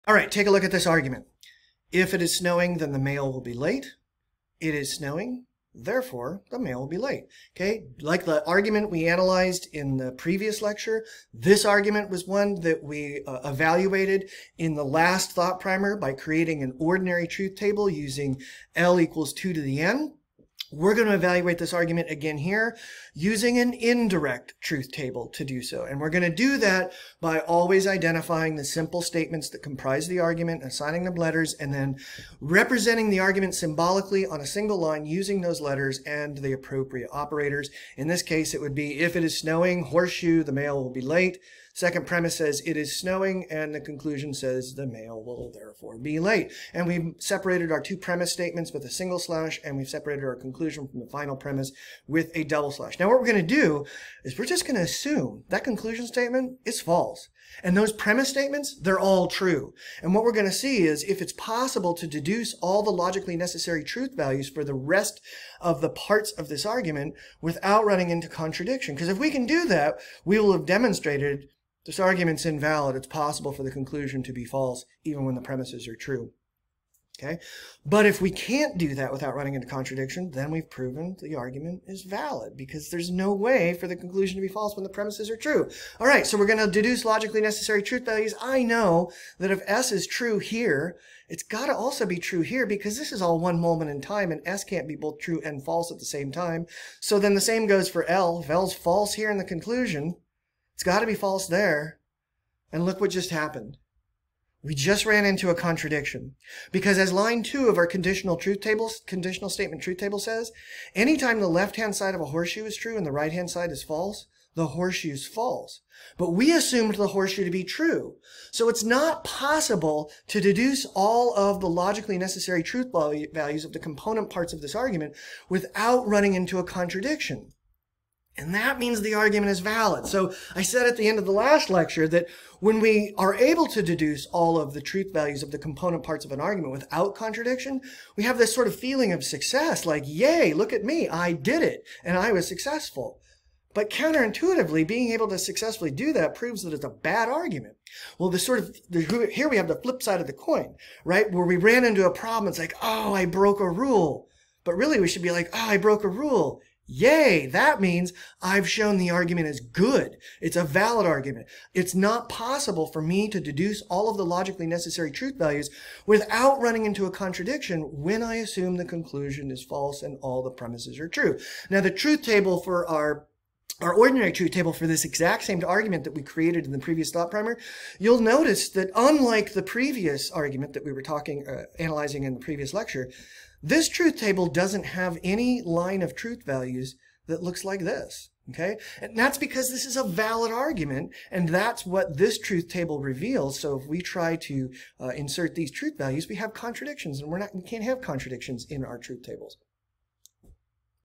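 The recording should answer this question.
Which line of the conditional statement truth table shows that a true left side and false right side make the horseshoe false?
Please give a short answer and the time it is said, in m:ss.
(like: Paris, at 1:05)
line 2, at 1:47.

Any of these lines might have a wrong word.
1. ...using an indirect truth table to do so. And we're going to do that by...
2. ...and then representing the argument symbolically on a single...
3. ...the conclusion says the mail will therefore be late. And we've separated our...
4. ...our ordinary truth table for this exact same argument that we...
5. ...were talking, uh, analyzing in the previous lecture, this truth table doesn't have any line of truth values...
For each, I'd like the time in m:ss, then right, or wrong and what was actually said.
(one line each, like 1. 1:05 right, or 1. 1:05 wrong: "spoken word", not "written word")
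1. 0:23 right
2. 0:31 right
3. 0:43 right
4. 2:53 right
5. 3:00 right.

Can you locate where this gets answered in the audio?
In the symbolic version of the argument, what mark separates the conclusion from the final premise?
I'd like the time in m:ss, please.
0:52.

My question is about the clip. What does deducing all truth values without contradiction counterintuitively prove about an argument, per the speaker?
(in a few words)
it's a bad argument.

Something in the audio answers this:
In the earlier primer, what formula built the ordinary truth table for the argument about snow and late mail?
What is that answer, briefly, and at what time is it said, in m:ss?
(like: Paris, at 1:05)
L = 2^n, at 0:18.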